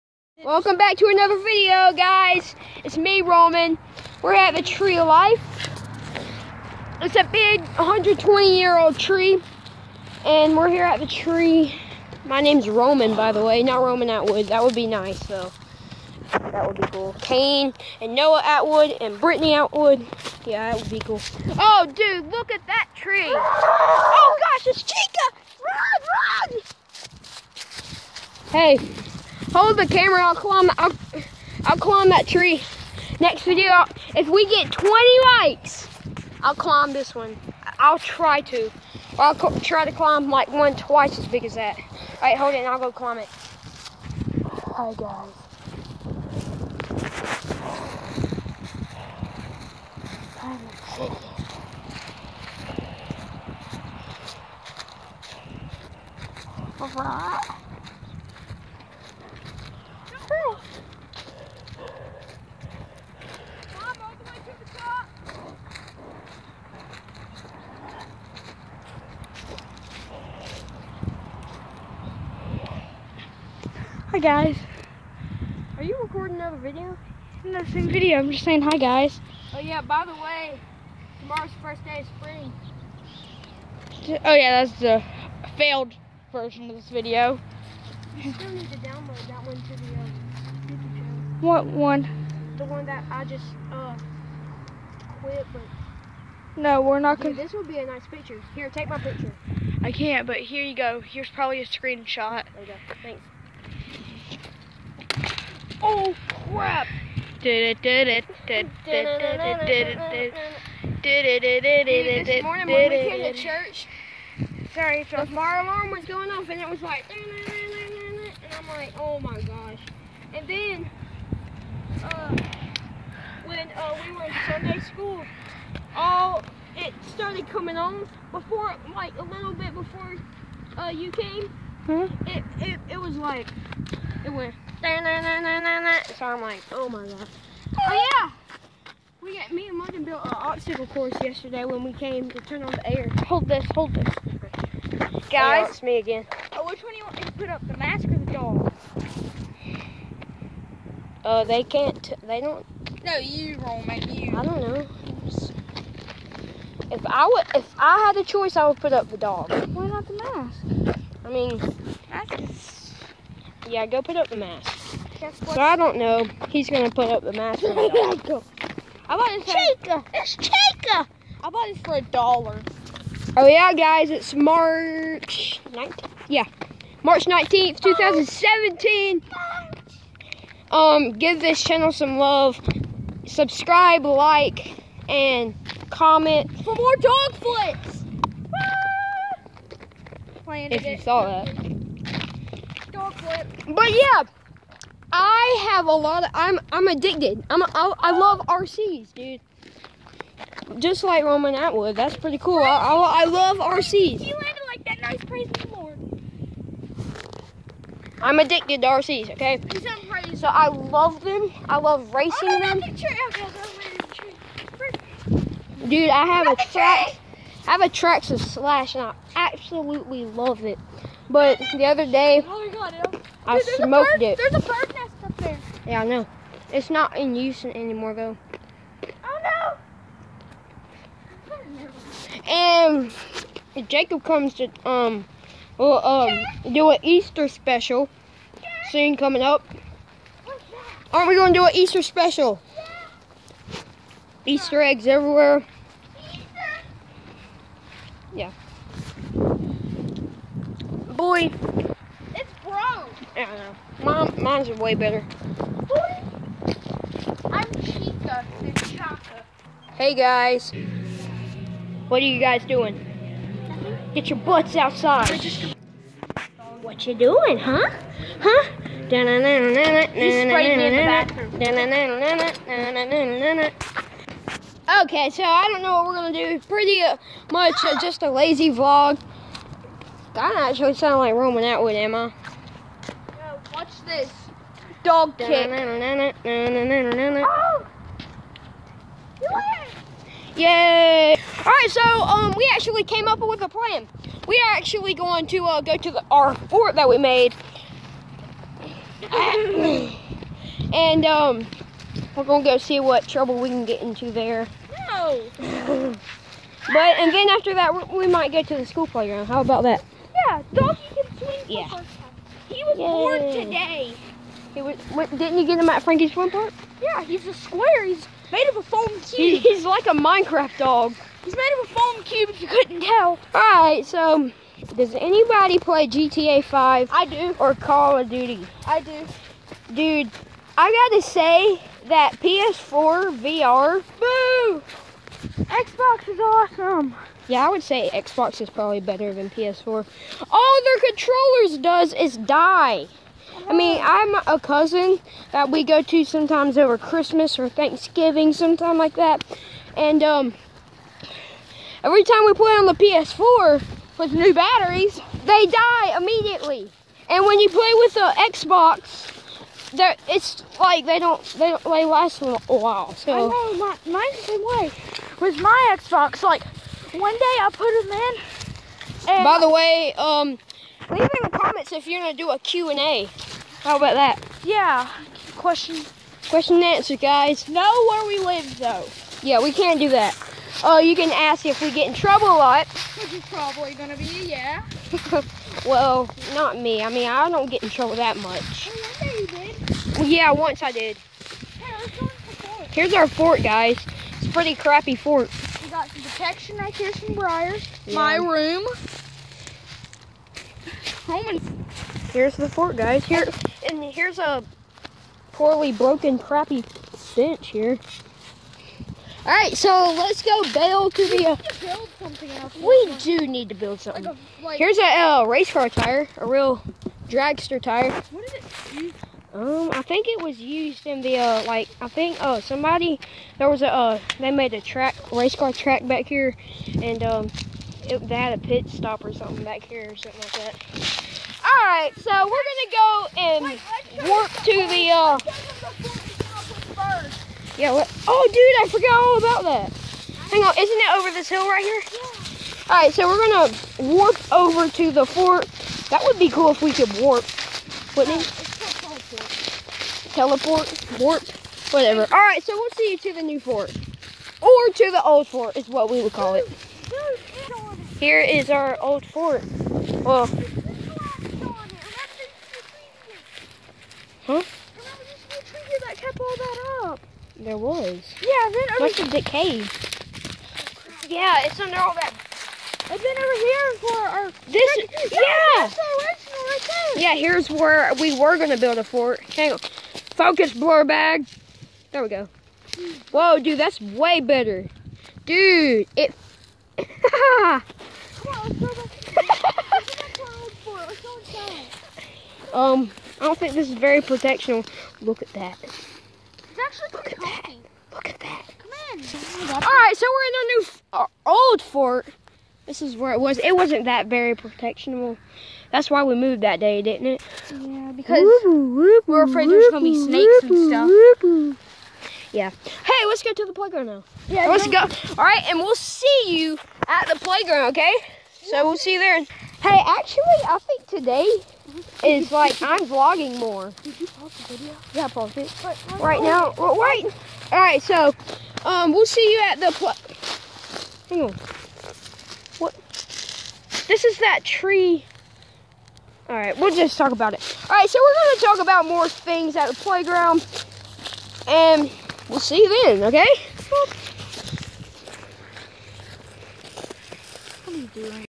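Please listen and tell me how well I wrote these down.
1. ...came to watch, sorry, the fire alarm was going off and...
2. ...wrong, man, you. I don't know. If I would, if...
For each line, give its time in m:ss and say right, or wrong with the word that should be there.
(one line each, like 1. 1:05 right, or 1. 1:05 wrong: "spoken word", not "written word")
1. 1:52 wrong: "church", not "watch"
2. 2:33 right.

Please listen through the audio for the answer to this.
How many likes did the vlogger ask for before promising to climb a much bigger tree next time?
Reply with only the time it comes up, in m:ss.
0:34.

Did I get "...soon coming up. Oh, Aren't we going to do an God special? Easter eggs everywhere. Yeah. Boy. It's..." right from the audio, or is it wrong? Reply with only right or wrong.
wrong.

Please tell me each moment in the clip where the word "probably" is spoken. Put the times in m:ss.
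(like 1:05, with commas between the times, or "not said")
1:41, 5:38, 6:23.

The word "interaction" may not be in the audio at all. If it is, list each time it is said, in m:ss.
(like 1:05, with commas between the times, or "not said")
not said.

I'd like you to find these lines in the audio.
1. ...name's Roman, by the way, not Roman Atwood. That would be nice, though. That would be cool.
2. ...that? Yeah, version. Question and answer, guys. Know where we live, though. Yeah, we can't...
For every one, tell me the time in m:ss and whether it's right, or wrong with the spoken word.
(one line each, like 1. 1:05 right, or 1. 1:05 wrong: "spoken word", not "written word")
1. 0:12 right
2. 6:14 wrong: "question", not "version".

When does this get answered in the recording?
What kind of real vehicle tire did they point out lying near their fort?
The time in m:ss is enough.
6:57.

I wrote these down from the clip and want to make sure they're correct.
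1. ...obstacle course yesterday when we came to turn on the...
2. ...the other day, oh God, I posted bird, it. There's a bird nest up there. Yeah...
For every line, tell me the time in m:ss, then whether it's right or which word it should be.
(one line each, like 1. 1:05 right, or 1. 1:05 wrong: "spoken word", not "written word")
1. 2:20 right
2. 3:41 wrong: "smoked", not "posted".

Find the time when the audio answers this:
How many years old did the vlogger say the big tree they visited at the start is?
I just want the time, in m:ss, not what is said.
0:07.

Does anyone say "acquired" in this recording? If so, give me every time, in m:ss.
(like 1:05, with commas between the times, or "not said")
not said.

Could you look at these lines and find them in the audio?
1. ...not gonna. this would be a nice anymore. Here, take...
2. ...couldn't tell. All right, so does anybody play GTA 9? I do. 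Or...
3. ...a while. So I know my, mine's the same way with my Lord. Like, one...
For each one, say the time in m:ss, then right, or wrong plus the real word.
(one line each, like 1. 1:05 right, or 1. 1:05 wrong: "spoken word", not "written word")
1. 1:36 wrong: "picture", not "anymore"
2. 5:22 wrong: "5", not "9"
3. 6:02 wrong: "Xbox", not "Lord".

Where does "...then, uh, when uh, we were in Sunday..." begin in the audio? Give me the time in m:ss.
2:00.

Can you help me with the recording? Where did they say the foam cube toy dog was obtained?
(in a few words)
Frankie's Fun Park.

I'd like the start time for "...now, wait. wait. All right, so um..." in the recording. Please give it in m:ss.
8:46.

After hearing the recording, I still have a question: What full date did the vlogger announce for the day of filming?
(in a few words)
March 19th, 2017.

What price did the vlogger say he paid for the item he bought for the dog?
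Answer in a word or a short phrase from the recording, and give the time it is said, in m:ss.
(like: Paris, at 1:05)
$1, at 2:51.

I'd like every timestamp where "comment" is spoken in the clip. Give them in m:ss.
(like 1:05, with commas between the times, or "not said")
3:05, 6:11.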